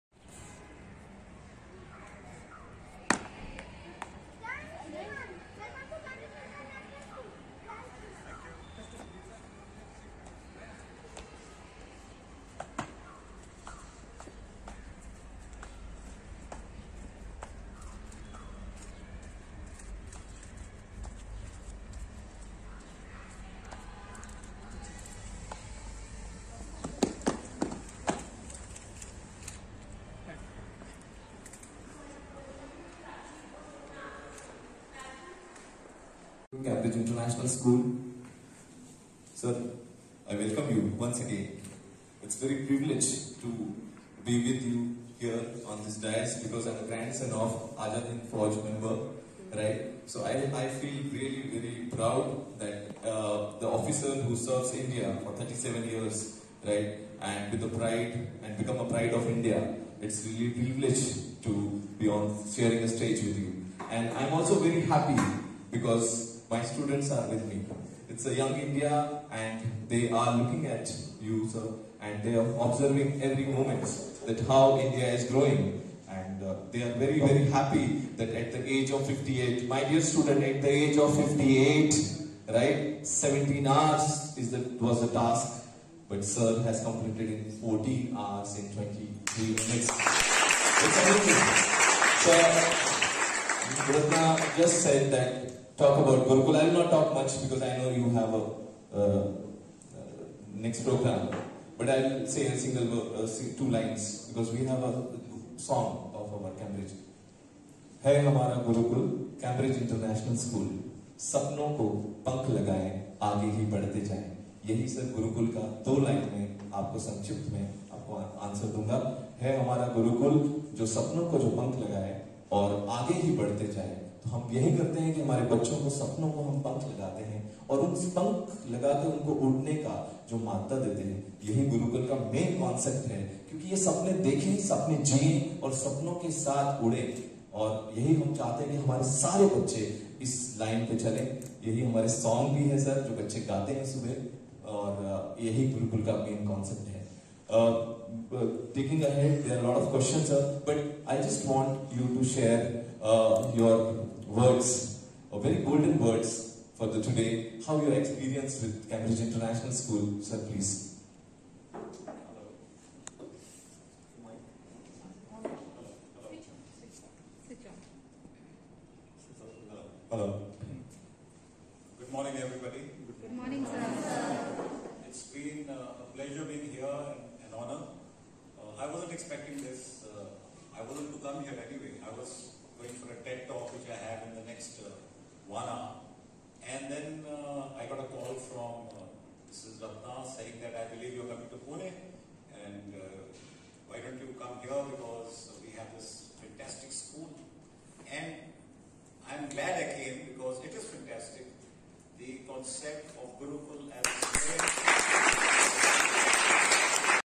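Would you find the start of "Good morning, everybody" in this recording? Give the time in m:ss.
2:51.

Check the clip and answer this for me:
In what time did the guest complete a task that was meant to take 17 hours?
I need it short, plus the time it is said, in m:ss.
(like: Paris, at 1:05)
14 hours 23 minutes, at 1:27.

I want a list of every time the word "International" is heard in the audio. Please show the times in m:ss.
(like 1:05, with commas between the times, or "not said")
0:36, 1:49, 2:39.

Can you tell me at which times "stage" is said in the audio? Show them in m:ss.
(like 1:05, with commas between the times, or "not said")
1:02.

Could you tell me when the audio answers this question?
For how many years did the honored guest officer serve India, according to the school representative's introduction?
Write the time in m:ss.
0:55.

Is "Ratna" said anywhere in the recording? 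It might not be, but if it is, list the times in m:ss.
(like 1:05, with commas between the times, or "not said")
1:33, 3:09.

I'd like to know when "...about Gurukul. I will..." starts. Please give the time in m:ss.
1:35.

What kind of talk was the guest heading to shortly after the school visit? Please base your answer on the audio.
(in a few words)
TED talk.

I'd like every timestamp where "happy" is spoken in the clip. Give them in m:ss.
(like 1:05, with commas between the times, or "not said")
1:04, 1:17.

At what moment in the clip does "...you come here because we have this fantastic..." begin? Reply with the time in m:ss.
3:14.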